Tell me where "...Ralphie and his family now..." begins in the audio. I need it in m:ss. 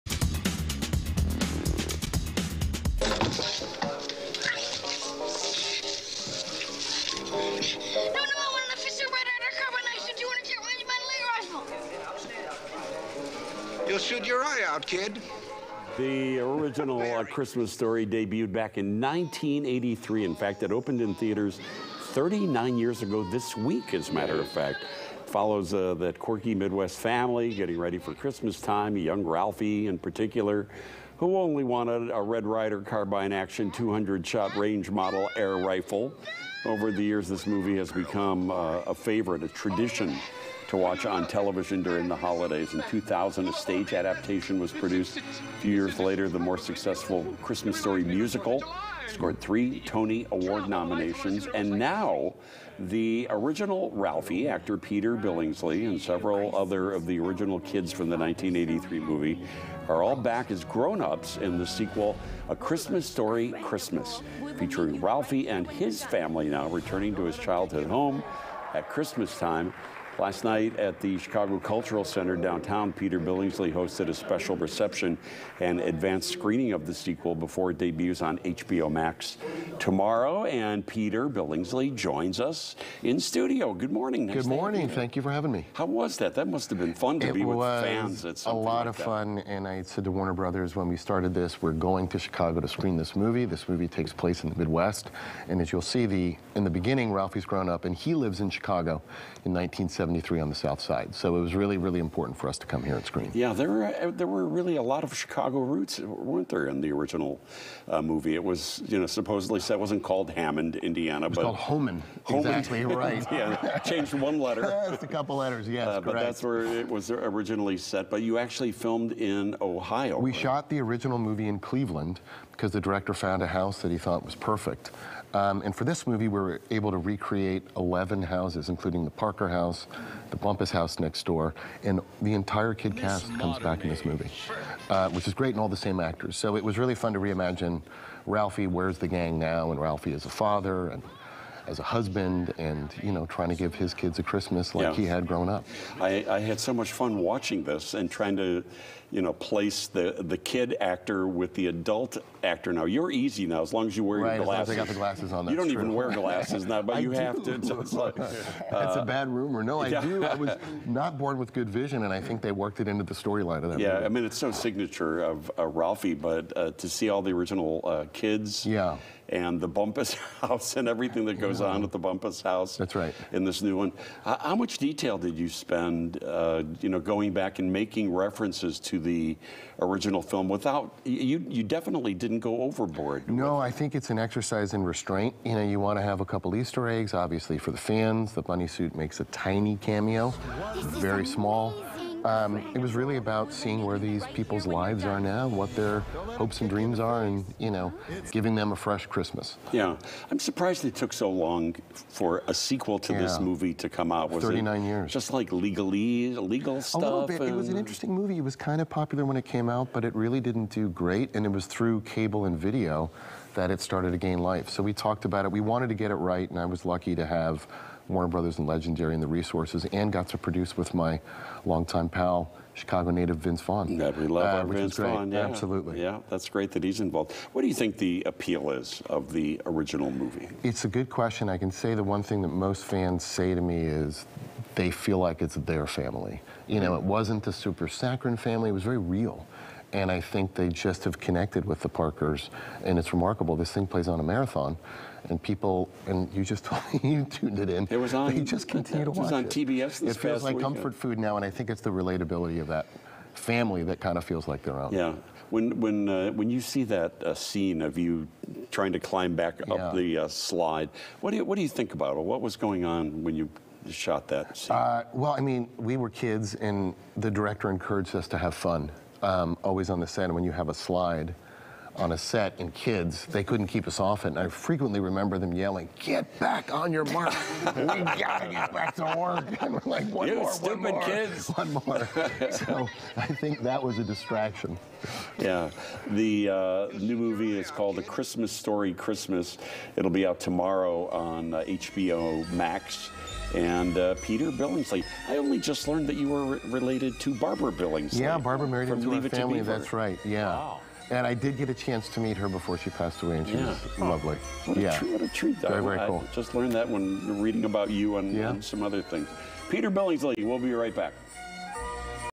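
1:05.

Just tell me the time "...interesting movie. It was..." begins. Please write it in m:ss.
3:27.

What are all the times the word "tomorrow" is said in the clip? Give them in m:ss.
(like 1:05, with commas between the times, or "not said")
1:19, 4:50.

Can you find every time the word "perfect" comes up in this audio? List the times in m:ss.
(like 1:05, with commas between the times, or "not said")
2:04.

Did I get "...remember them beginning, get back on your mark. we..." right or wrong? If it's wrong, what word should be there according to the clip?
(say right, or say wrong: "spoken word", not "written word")
wrong: "yelling", not "beginning".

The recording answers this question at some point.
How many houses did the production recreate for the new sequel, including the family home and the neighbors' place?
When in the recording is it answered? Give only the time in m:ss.
2:07.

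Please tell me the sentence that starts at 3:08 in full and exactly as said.
The bunny suit makes a tiny cameo, very small.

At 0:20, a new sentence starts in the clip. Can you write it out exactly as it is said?
In fact, it opened in theaters 39 years ago this week, as a matter of fact.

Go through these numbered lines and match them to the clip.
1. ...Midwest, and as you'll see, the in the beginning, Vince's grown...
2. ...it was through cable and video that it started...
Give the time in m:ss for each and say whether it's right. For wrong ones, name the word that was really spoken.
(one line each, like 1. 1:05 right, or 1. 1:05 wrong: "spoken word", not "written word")
1. 1:34 wrong: "Ralphie", not "Vince"
2. 3:31 right.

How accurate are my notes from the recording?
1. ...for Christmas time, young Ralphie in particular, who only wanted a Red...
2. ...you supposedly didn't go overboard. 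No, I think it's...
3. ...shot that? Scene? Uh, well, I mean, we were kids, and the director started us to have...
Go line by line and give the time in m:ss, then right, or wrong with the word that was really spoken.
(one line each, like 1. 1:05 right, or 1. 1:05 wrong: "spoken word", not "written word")
1. 0:27 right
2. 3:01 wrong: "definitely", not "supposedly"
3. 4:23 wrong: "encouraged", not "started".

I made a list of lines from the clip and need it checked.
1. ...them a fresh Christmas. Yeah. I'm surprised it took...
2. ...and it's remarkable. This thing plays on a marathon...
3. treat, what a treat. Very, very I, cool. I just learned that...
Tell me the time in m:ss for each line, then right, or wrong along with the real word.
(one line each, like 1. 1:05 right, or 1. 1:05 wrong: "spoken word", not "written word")
1. 3:18 right
2. 4:02 right
3. 5:04 right.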